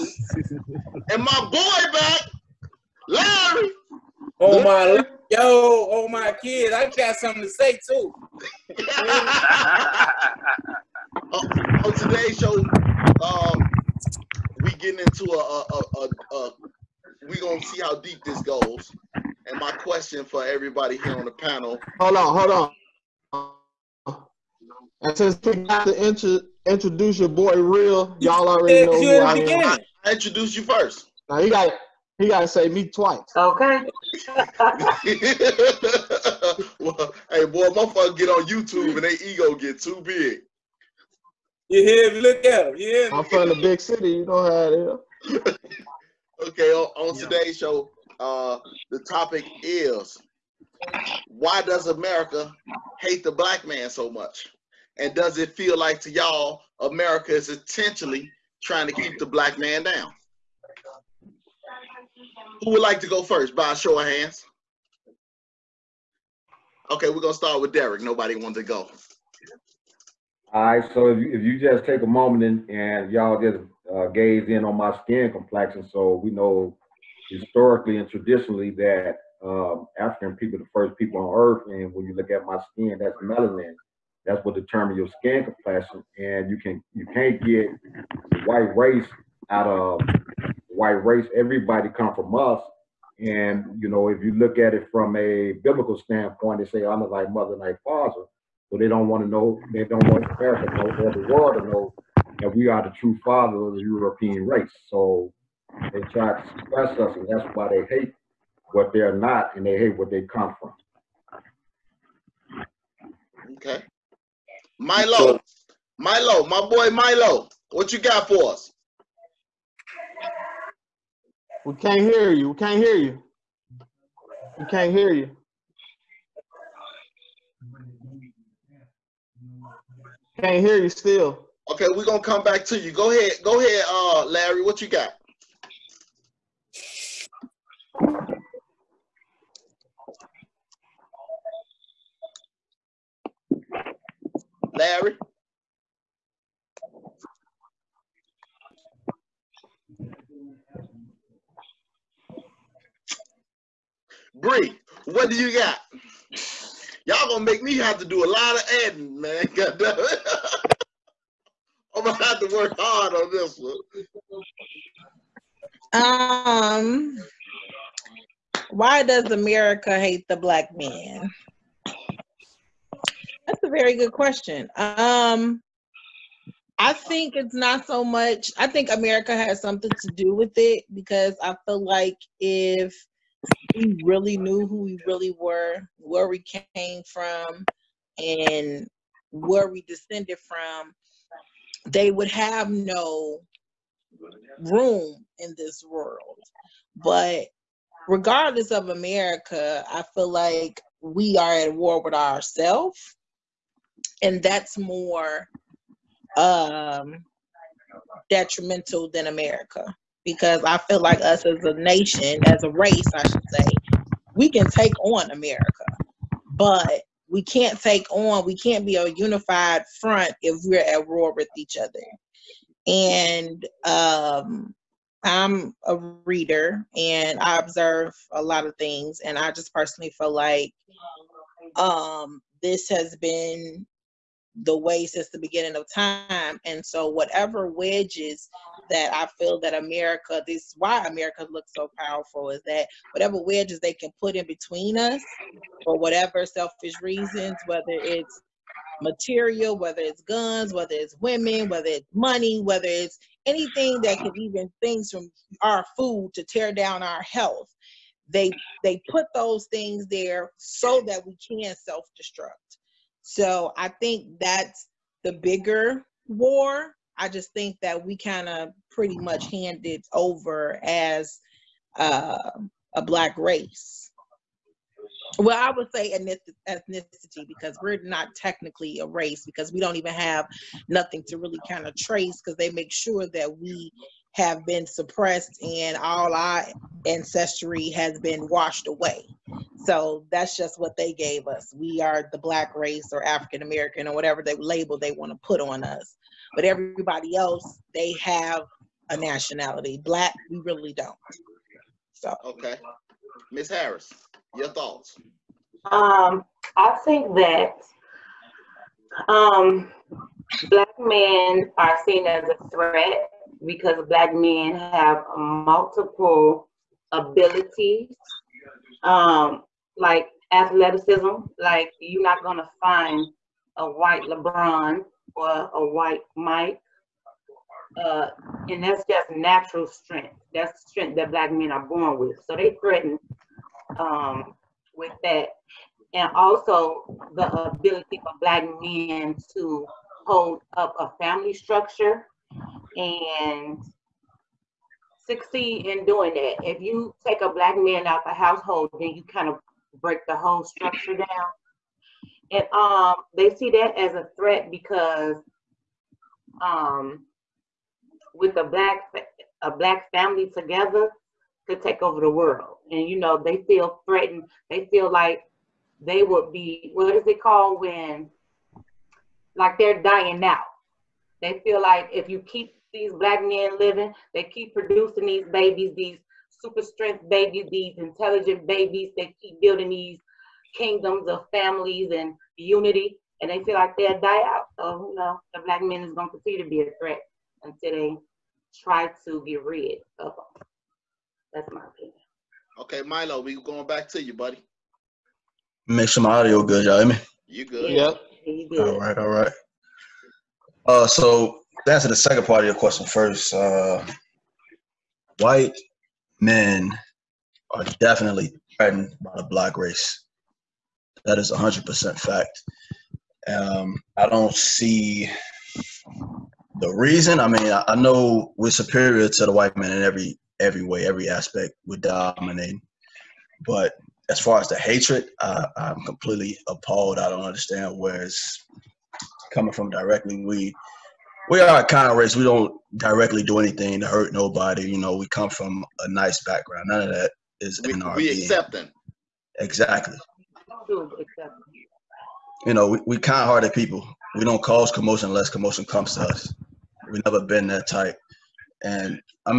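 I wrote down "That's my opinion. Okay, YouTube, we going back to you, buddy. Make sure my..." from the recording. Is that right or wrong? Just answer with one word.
wrong.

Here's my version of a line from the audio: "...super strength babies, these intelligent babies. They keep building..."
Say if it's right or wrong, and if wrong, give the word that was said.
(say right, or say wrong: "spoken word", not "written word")
right.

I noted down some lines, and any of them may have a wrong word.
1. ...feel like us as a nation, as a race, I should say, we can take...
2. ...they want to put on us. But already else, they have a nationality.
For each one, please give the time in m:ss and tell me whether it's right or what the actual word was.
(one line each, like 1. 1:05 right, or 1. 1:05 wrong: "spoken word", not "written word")
1. 3:30 right
2. 4:54 wrong: "everybody", not "already".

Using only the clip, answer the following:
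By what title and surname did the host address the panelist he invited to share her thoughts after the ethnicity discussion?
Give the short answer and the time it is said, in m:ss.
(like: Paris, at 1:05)
Miss Harris, at 5:03.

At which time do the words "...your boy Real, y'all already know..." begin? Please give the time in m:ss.
0:27.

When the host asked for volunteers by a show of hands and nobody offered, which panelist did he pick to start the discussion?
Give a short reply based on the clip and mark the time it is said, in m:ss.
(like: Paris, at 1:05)
Derek, at 1:07.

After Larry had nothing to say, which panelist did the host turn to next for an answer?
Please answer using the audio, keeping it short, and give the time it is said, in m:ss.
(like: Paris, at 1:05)
Bree, at 2:34.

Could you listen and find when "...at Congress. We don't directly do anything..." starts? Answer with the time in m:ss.
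7:11.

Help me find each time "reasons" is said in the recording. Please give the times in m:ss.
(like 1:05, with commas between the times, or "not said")
4:07, 6:56.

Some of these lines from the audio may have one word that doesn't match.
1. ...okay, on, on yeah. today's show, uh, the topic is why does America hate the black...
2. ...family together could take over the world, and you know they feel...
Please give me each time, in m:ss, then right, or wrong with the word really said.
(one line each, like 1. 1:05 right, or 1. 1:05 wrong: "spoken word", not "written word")
1. 0:46 right
2. 6:00 right.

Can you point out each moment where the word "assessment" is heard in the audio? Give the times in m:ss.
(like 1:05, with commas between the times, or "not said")
not said.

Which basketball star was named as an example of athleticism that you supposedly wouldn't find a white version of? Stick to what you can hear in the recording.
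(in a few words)
LeBron.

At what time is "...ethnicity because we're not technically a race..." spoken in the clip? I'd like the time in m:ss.
4:36.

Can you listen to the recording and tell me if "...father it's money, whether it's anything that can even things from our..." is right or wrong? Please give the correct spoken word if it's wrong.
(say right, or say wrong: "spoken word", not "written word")
wrong: "whether", not "father".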